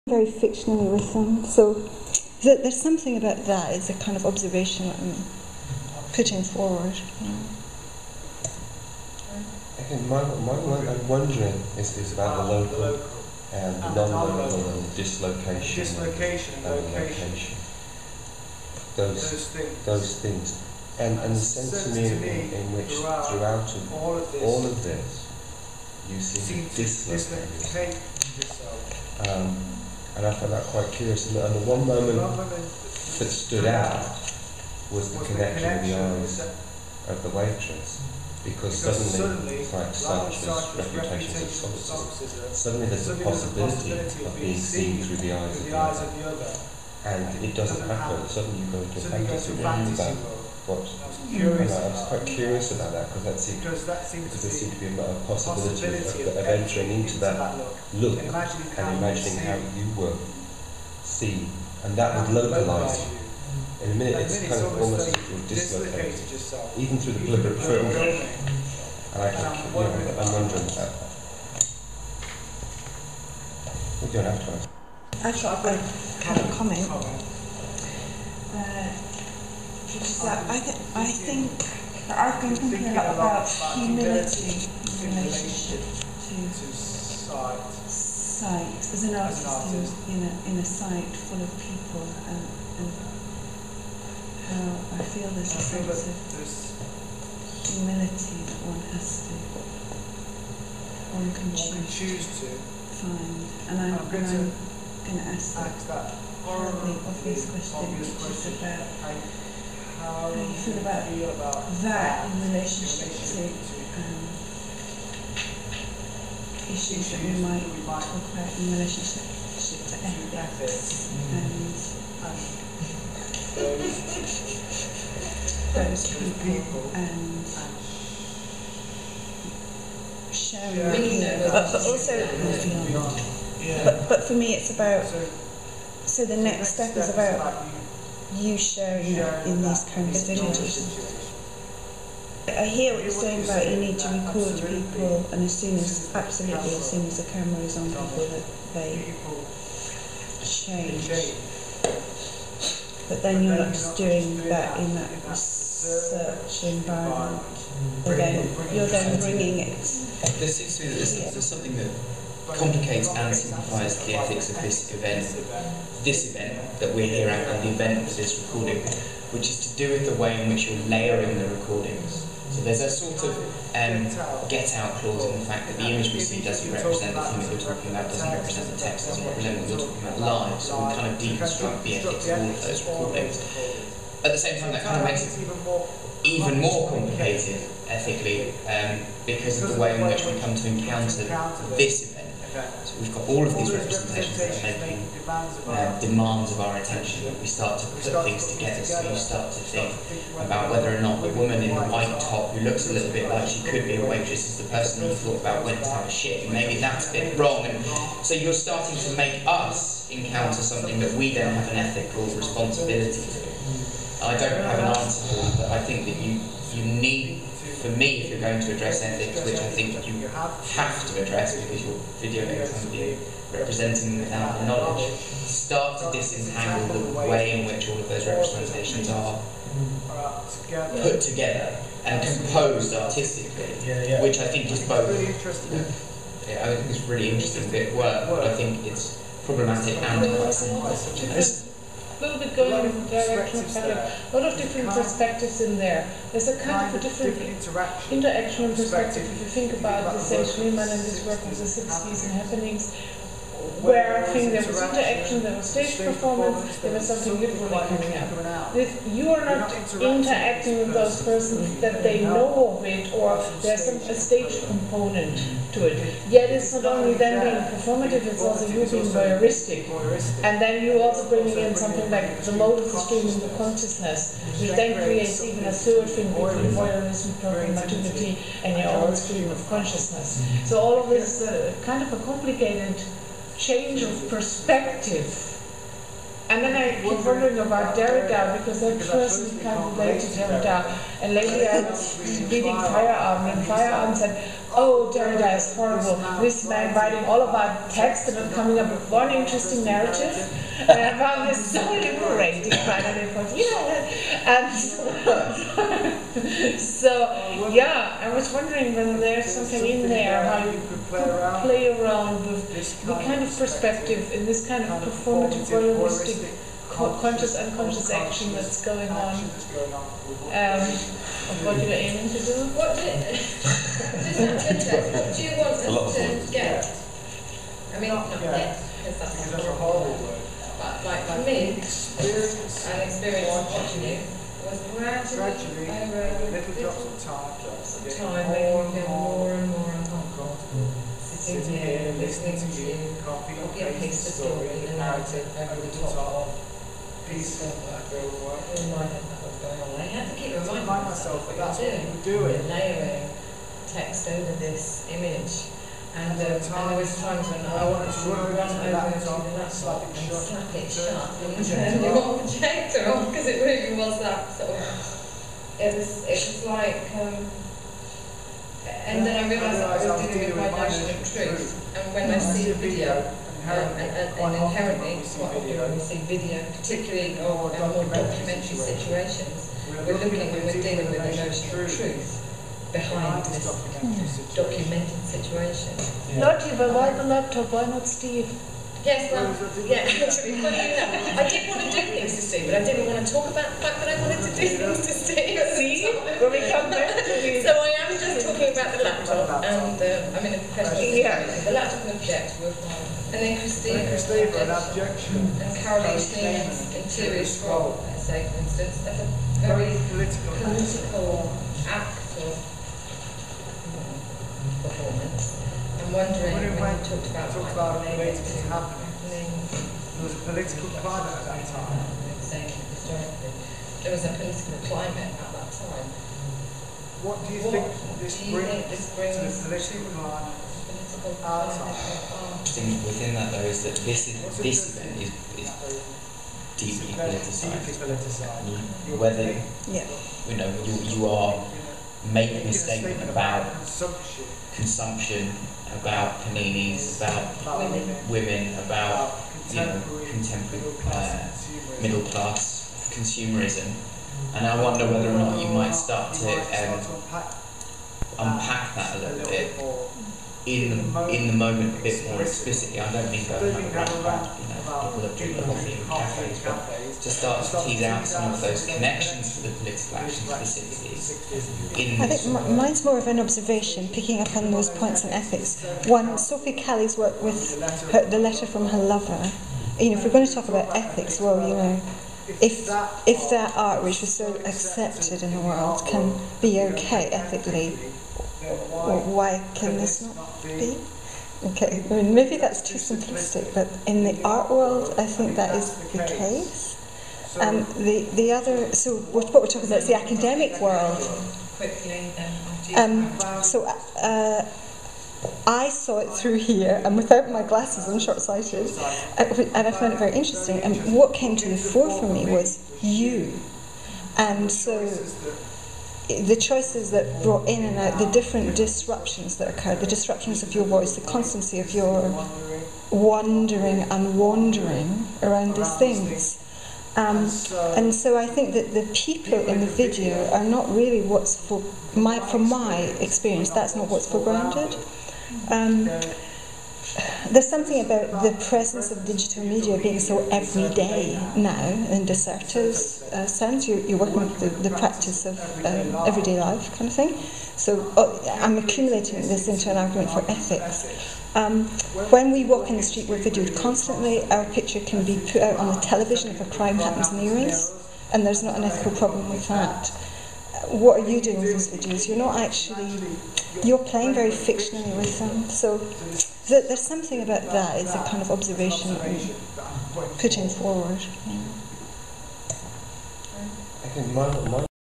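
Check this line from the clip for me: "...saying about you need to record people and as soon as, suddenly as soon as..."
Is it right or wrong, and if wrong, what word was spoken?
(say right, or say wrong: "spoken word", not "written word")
wrong: "absolutely", not "suddenly".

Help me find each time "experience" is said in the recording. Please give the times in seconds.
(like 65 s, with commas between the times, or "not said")
331 s, 533 s.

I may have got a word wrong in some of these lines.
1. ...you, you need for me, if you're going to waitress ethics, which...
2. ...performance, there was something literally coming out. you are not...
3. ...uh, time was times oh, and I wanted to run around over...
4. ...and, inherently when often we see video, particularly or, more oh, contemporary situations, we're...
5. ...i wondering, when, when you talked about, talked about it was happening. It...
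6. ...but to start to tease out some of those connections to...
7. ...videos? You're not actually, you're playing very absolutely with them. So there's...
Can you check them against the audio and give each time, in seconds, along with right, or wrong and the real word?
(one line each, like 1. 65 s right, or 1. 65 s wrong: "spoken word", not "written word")
1. 216 s wrong: "address", not "waitress"
2. 255 s right
3. 356 s right
4. 374 s wrong: "documentary", not "contemporary"
5. 416 s right
6. 466 s right
7. 561 s wrong: "fictionally", not "absolutely".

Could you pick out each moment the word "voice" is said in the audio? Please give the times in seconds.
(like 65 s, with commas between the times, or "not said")
520 s.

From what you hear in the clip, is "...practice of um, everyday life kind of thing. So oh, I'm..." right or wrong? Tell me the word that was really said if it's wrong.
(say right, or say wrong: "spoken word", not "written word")
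right.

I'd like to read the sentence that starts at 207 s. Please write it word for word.
And so you're starting to make us encounter something that we then have an ethical responsibility to.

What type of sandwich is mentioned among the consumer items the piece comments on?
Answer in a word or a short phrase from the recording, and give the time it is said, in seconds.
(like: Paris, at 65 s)
paninis, at 446 s.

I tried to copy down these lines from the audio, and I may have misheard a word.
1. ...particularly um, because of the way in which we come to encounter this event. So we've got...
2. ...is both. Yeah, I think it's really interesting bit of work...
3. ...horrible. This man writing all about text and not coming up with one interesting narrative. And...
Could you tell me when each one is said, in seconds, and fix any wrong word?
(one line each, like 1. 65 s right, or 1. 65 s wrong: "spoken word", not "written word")
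1. 187 s wrong: "ethically", not "particularly"
2. 234 s right
3. 295 s right.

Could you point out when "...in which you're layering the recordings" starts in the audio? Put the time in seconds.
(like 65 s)
170 s.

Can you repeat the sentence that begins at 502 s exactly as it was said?
Um, so uh, I saw it through here, and without my glasses, I'm short sighted, uh, and I found it very interesting.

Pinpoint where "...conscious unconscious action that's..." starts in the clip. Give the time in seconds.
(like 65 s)
316 s.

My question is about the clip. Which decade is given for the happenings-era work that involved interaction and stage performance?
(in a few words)
the 60s.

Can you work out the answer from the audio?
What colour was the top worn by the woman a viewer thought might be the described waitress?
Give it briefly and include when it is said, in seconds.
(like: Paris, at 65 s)
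white, at 201 s.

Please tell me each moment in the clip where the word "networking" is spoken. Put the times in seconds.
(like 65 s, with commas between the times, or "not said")
not said.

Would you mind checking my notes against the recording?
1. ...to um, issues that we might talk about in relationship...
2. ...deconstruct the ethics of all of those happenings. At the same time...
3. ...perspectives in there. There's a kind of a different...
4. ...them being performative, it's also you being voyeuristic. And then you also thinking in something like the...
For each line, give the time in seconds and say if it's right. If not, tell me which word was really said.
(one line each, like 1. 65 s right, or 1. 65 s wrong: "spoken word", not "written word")
1. 113 s right
2. 181 s wrong: "recordings", not "happenings"
3. 244 s right
4. 267 s wrong: "bringing", not "thinking".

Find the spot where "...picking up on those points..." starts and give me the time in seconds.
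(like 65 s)
474 s.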